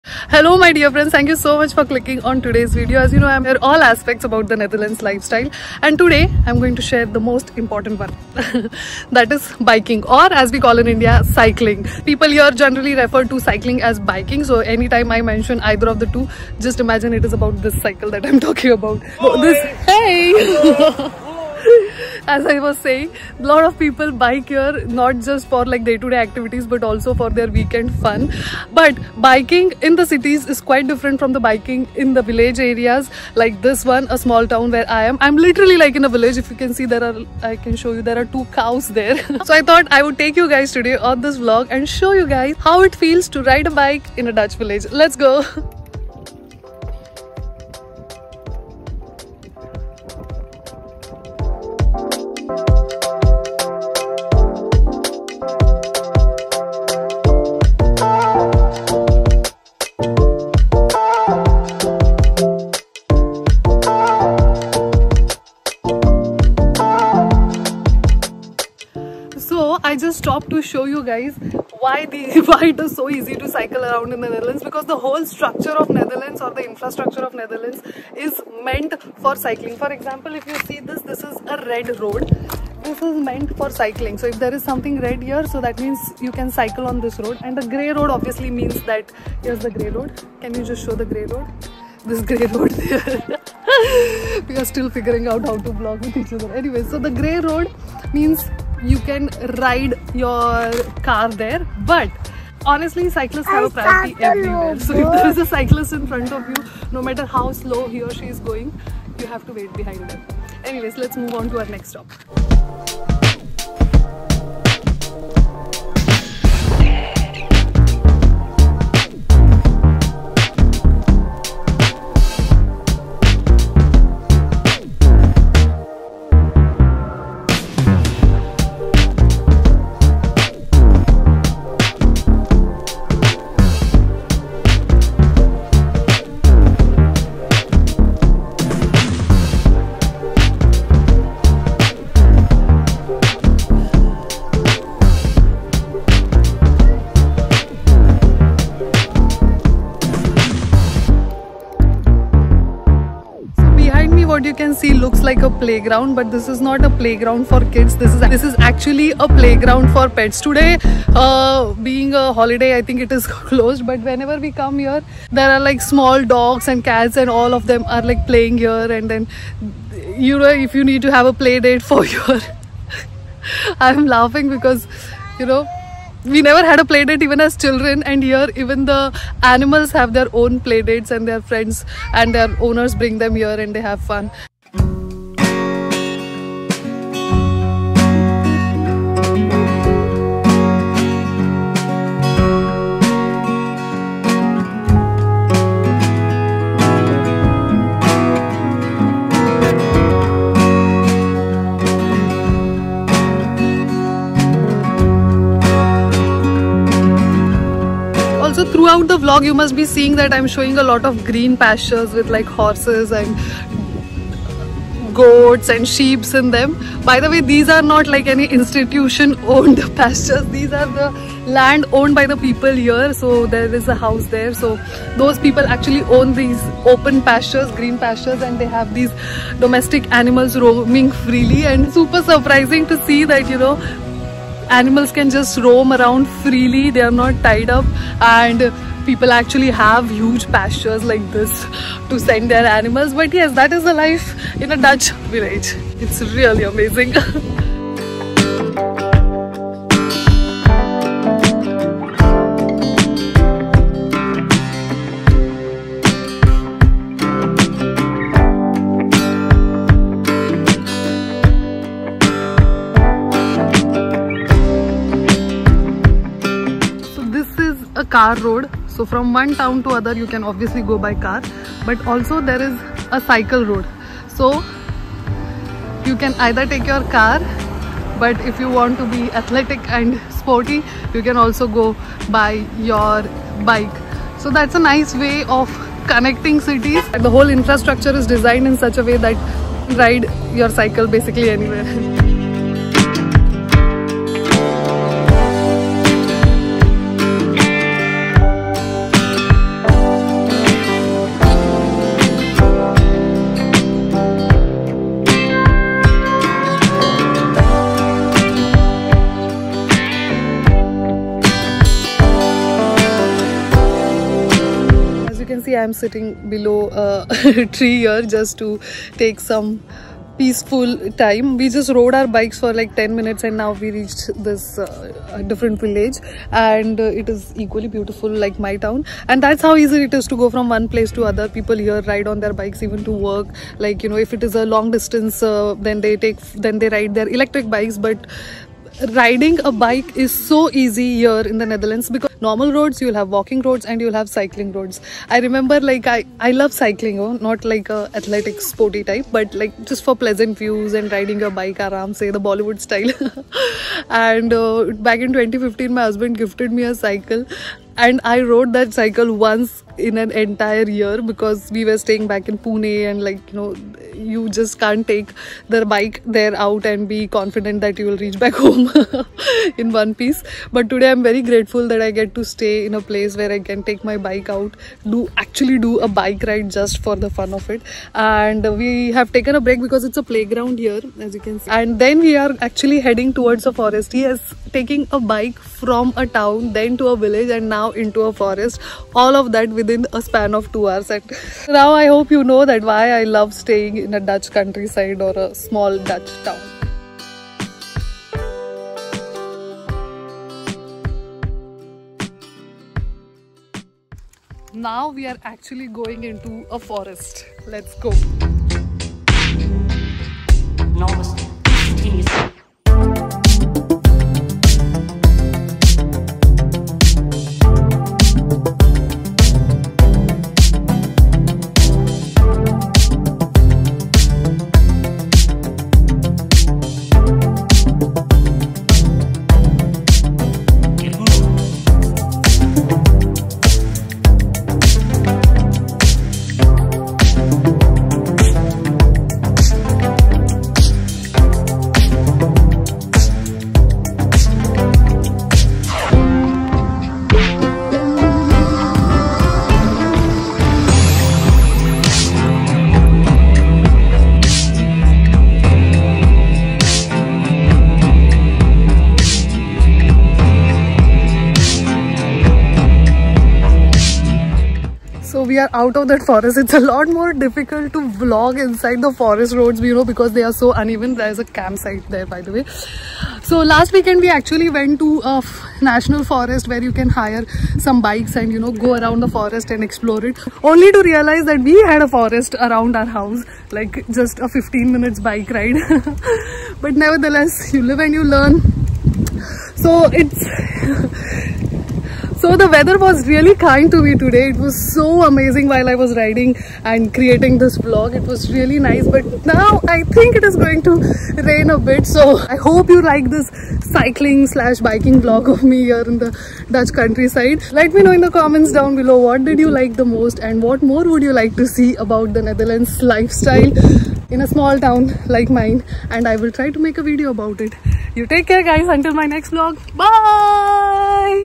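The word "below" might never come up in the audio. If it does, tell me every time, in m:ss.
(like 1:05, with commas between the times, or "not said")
5:16, 8:28.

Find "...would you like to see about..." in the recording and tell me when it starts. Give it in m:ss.
8:31.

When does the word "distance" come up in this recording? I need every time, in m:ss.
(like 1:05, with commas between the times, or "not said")
5:34.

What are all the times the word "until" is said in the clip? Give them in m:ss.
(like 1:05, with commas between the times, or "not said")
8:38.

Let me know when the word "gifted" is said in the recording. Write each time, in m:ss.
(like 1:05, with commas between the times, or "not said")
5:56.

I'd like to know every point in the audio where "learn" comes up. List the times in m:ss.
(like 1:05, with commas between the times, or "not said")
8:08.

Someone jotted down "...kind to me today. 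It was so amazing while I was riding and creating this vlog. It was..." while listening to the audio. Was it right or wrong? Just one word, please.
right.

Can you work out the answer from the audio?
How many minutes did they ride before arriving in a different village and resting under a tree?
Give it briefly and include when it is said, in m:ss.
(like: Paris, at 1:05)
10 minutes, at 5:22.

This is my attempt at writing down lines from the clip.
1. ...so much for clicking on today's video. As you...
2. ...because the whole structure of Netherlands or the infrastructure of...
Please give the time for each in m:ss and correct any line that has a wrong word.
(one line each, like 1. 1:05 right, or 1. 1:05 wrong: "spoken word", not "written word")
1. 0:01 right
2. 1:14 right.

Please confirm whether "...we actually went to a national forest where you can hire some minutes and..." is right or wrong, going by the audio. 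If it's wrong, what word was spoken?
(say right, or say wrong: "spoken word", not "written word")
wrong: "bikes", not "minutes".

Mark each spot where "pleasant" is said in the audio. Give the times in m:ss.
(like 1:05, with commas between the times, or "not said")
5:50.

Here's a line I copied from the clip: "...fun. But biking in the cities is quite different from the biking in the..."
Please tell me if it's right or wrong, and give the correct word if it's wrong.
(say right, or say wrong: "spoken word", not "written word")
right.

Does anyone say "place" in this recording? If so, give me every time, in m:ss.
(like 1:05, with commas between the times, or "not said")
5:30, 6:13.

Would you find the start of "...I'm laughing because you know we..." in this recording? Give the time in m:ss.
2:53.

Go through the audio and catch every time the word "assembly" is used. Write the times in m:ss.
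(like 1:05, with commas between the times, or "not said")
not said.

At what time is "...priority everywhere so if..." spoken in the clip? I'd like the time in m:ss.
1:43.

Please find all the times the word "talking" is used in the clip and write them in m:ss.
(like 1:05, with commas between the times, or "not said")
0:18.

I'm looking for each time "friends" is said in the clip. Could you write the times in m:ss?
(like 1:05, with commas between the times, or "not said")
0:00, 3:01.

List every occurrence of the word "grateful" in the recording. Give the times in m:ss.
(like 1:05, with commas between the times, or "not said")
6:11.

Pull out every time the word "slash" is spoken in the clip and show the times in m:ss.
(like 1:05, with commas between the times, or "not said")
8:24.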